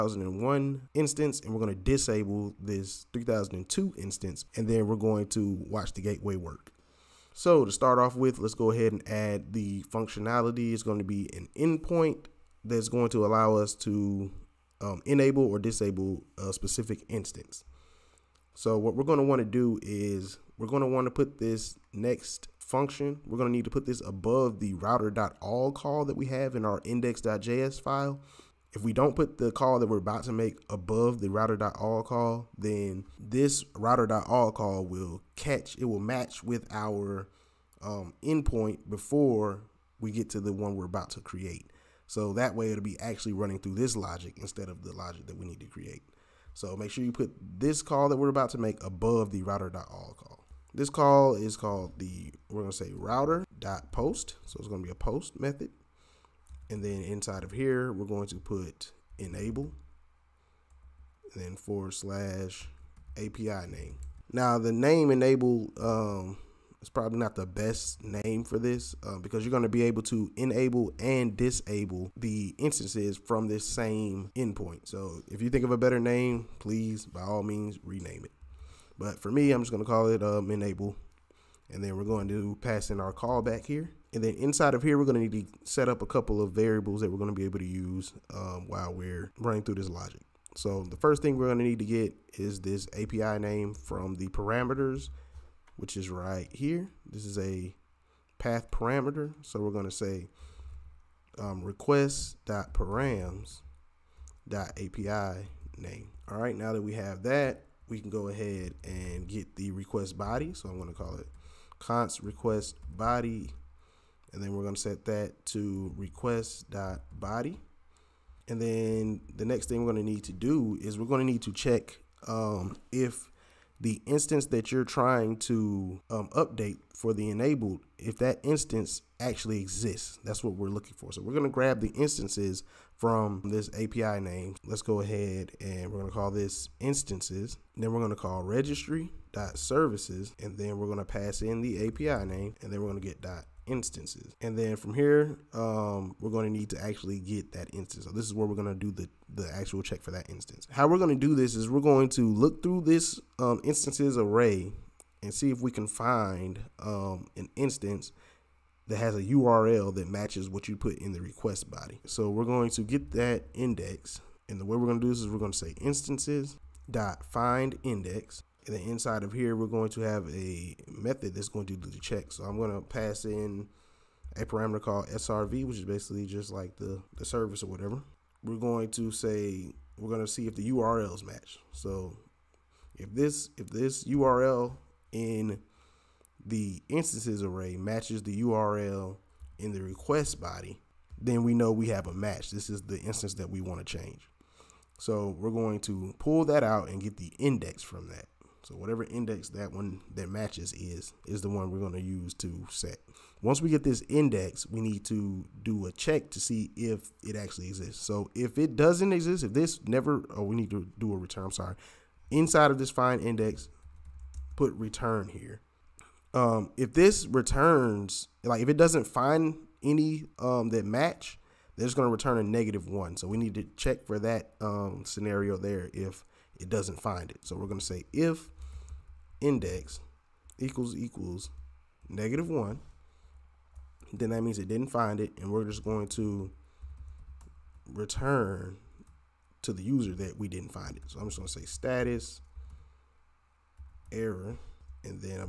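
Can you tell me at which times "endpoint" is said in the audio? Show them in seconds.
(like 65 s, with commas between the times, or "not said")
11 s, 38 s, 74 s.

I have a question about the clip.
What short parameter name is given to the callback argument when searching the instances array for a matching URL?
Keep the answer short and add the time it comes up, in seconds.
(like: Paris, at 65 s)
SRV, at 175 s.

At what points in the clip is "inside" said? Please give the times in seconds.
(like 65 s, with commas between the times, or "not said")
57 s, 84 s, 168 s, 212 s.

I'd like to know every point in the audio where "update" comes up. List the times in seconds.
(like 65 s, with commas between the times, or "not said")
126 s.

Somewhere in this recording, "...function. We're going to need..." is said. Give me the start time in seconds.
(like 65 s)
22 s.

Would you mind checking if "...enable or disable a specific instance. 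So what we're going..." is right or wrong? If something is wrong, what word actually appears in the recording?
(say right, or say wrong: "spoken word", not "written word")
right.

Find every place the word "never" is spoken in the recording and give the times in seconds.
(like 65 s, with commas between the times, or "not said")
209 s.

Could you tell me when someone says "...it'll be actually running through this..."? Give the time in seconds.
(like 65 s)
42 s.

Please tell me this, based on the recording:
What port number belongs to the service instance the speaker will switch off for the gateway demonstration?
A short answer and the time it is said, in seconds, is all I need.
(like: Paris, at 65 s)
3002, at 3 s.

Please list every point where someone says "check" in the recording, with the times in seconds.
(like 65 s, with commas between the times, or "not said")
121 s, 149 s, 171 s, 205 s, 223 s.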